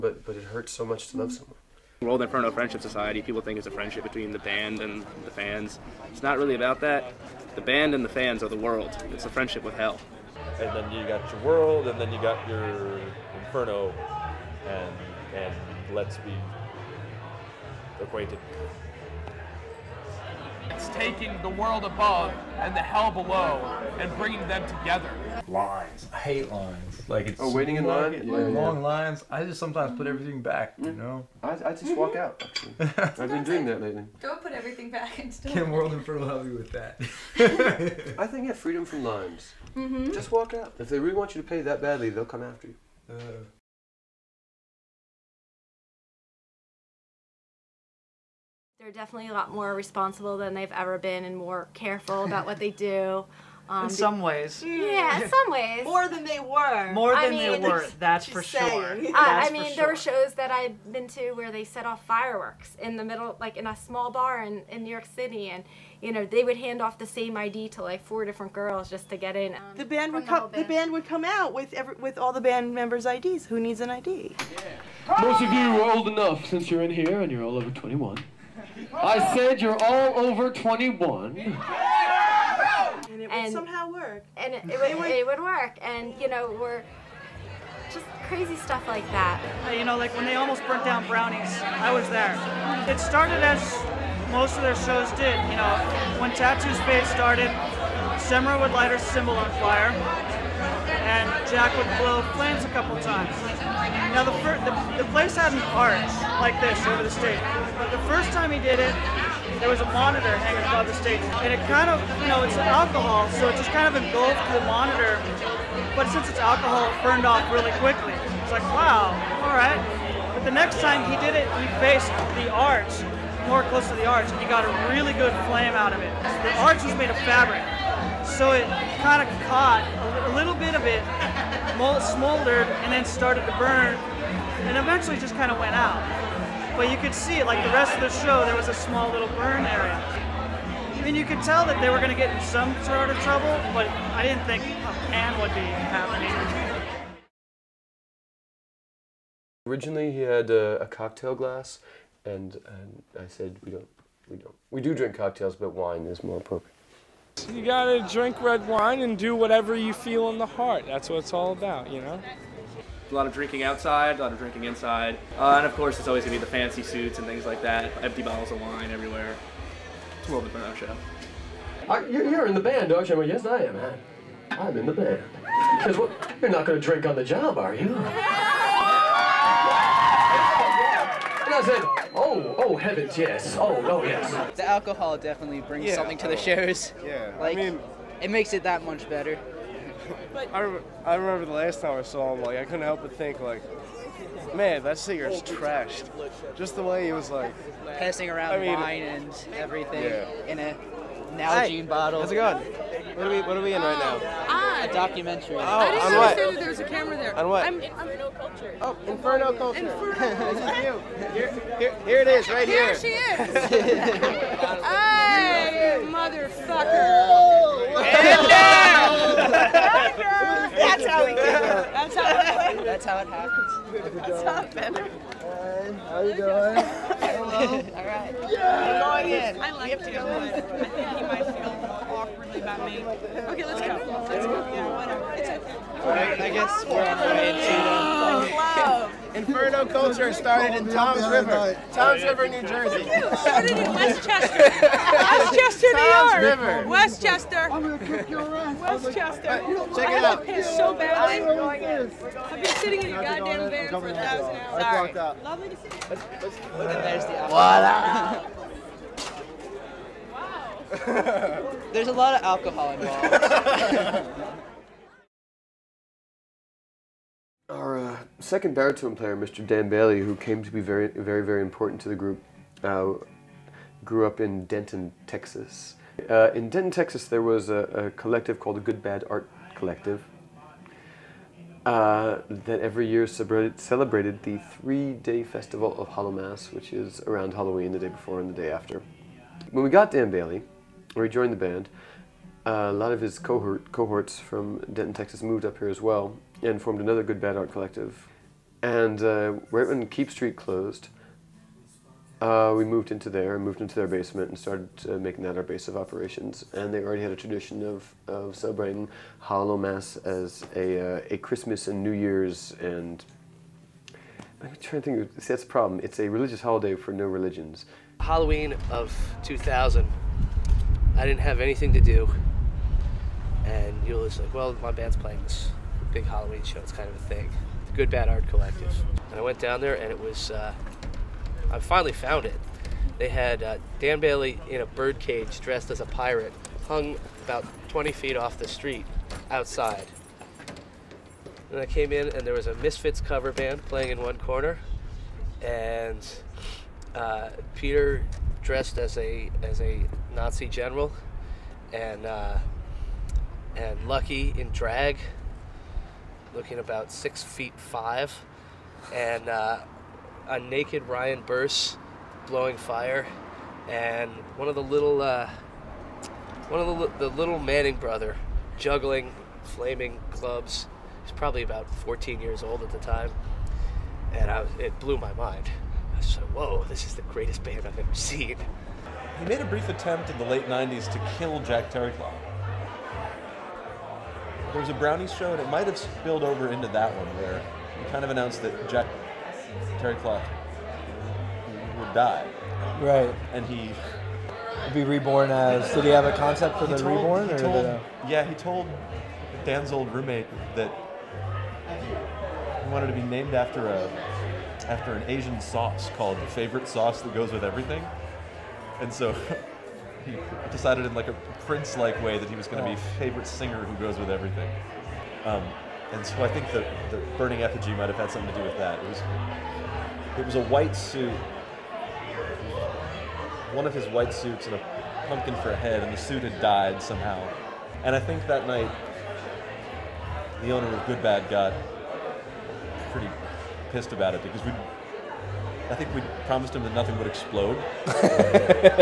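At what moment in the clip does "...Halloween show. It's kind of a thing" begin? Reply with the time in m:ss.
5:26.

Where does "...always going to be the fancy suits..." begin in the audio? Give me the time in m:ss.
2:46.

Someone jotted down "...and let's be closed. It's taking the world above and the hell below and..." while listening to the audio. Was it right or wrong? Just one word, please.
wrong.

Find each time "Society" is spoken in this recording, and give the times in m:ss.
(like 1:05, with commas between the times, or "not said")
0:02.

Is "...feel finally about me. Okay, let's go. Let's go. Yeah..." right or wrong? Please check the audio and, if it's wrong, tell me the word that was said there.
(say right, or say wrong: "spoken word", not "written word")
wrong: "awkwardly", not "finally".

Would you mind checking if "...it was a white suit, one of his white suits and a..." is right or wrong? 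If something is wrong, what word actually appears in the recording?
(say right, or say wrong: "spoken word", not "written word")
right.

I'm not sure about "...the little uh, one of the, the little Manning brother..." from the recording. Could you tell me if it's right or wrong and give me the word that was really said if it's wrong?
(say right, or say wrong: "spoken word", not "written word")
right.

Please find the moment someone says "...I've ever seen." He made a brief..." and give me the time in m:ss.
6:17.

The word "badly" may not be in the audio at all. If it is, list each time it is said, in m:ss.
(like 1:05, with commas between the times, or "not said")
0:41, 4:10.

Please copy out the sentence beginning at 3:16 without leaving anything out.
Just the way he was like passing around I mean, wine and everything yeah.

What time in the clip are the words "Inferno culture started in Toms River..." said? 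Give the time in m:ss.
3:59.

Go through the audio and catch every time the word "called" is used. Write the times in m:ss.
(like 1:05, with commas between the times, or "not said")
4:38, 6:46.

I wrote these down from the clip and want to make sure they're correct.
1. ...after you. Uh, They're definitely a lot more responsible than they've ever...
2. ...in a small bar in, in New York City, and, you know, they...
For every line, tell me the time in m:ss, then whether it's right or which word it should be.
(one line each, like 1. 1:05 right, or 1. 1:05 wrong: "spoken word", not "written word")
1. 0:42 right
2. 1:03 right.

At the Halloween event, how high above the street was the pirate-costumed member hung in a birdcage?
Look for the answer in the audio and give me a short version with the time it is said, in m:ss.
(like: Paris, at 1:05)
20 feet, at 5:37.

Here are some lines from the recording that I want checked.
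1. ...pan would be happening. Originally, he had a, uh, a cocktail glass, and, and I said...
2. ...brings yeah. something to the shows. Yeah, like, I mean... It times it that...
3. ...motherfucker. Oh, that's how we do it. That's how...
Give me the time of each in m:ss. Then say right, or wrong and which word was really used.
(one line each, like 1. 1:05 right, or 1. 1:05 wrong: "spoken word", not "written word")
1. 2:25 right
2. 3:05 wrong: "makes", not "times"
3. 3:36 right.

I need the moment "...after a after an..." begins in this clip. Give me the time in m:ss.
6:43.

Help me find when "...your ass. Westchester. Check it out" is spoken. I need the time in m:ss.
4:08.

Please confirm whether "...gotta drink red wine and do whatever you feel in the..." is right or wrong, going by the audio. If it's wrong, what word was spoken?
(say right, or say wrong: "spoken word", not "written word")
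right.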